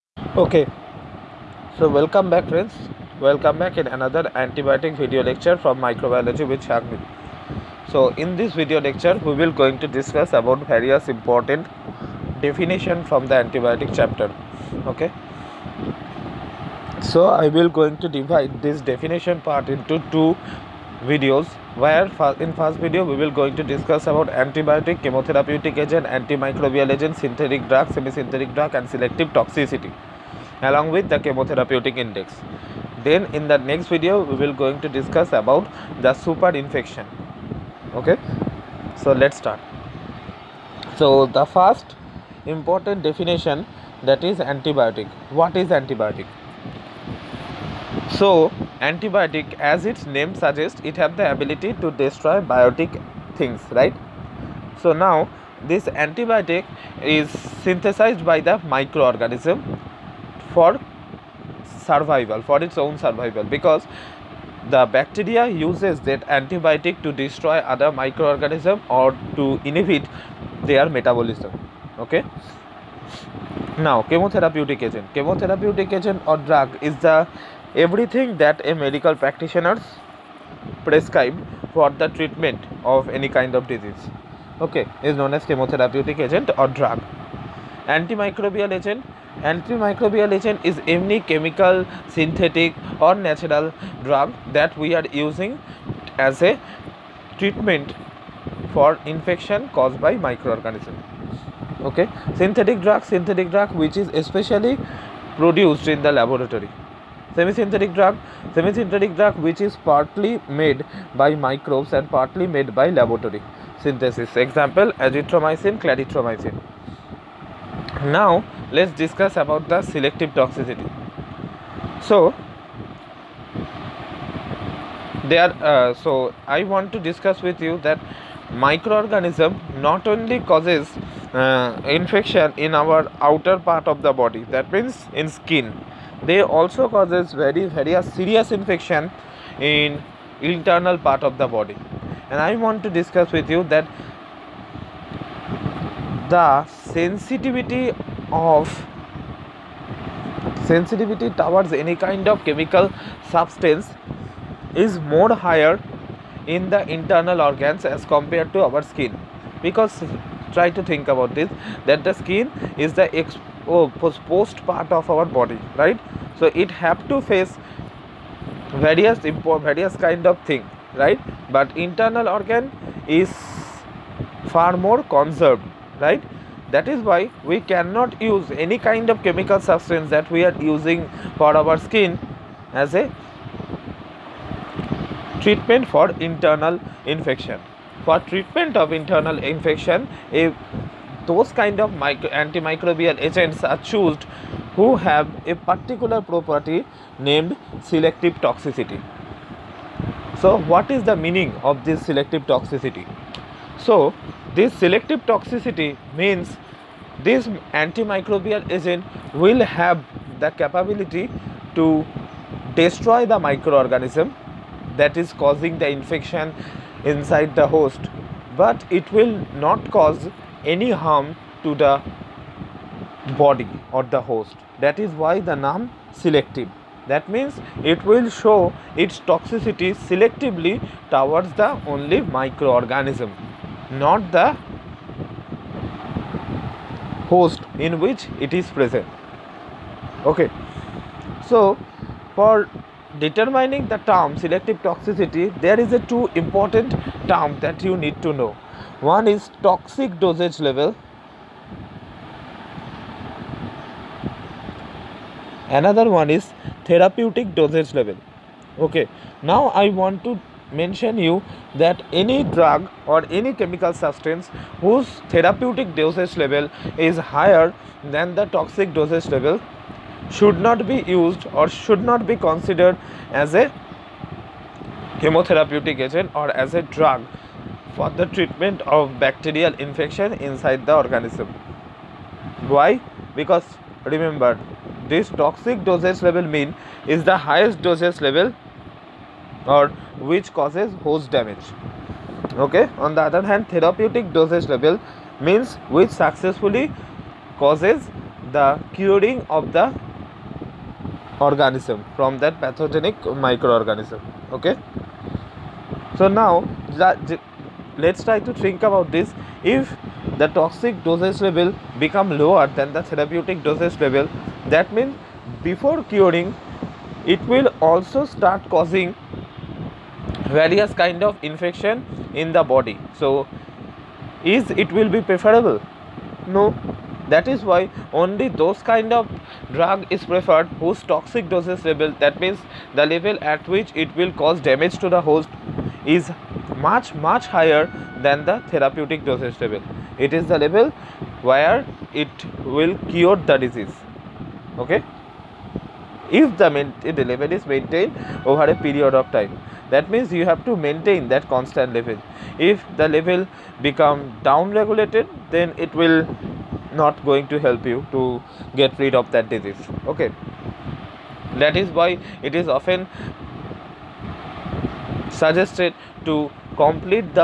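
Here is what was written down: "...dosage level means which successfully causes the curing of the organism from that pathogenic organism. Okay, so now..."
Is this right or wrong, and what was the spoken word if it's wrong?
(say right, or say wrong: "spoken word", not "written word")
wrong: "microorganism", not "organism".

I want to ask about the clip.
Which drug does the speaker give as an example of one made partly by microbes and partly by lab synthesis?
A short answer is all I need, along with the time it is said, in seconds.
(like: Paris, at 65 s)
Azithromycin, at 115 s.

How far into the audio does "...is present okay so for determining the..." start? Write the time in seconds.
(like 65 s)
238 s.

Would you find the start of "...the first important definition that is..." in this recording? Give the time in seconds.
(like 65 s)
41 s.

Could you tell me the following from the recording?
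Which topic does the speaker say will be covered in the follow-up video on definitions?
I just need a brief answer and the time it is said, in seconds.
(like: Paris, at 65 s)
Super infection, at 36 s.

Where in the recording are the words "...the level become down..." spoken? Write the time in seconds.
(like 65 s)
352 s.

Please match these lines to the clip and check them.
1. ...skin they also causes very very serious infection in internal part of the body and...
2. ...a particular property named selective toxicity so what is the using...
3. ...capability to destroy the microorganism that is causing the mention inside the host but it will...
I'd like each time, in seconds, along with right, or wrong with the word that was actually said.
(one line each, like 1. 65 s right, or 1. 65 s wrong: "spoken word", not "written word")
1. 135 s right
2. 195 s wrong: "meaning", not "using"
3. 210 s wrong: "infection", not "mention".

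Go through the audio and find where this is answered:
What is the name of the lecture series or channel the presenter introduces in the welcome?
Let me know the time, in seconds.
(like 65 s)
5 s.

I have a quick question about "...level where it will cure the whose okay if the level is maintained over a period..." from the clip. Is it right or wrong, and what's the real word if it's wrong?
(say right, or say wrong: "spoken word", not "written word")
wrong: "disease", not "whose".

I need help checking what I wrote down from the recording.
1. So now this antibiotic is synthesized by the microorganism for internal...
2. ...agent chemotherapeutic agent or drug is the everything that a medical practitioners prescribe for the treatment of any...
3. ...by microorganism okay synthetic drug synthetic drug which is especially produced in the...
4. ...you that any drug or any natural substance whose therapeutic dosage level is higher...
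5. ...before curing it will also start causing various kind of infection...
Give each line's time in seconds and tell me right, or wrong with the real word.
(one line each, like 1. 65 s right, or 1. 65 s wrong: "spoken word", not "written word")
1. 54 s wrong: "survival", not "internal"
2. 74 s right
3. 100 s right
4. 261 s wrong: "chemical", not "natural"
5. 315 s right.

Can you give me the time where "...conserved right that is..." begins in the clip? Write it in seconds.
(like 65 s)
175 s.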